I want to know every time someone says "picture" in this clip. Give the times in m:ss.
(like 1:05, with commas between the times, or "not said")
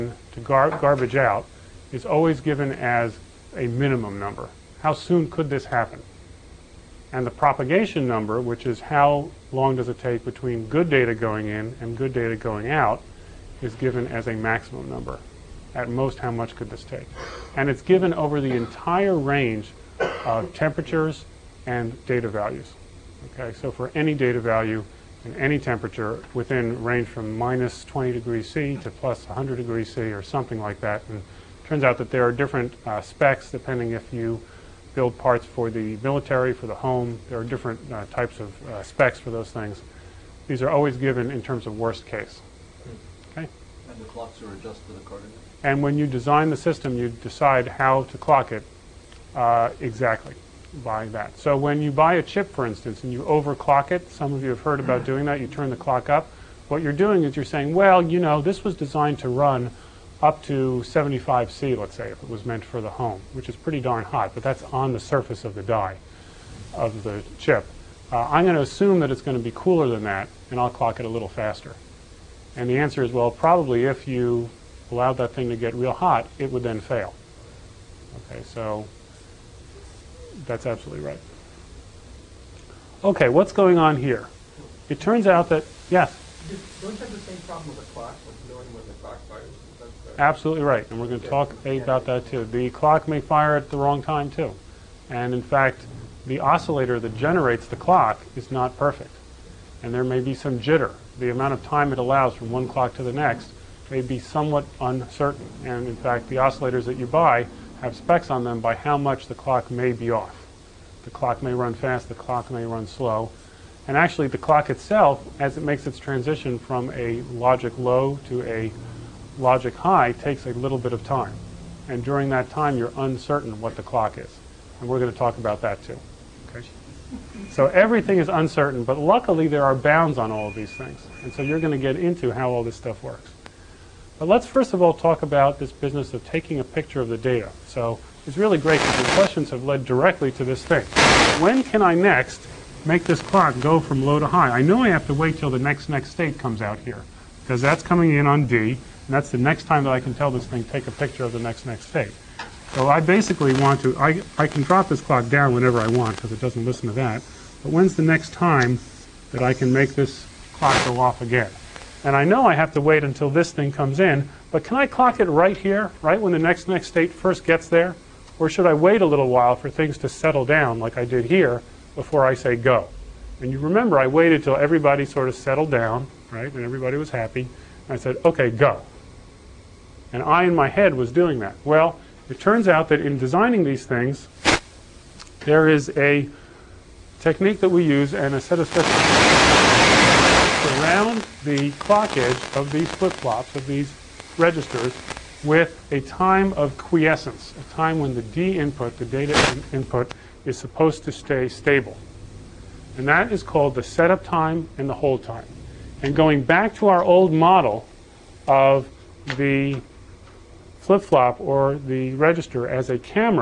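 2:16, 2:30.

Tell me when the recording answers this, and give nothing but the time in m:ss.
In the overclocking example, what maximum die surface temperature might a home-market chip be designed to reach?
1:00.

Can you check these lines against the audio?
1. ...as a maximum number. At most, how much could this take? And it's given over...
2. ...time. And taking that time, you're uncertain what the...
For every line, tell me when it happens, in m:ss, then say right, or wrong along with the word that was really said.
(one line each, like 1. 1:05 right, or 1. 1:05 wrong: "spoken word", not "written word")
1. 0:14 right
2. 2:01 wrong: "during", not "taking".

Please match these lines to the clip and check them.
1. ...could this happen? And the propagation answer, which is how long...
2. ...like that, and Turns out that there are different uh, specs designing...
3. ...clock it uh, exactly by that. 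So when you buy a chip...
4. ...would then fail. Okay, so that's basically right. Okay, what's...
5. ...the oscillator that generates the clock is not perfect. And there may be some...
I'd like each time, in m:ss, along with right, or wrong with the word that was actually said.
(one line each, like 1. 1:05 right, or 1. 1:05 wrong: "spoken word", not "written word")
1. 0:05 wrong: "number", not "answer"
2. 0:30 wrong: "depending", not "designing"
3. 0:48 right
4. 1:16 wrong: "absolutely", not "basically"
5. 1:36 right.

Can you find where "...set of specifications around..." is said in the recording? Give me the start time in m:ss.
3:08.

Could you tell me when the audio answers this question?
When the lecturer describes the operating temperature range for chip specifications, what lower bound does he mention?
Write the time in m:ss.
0:27.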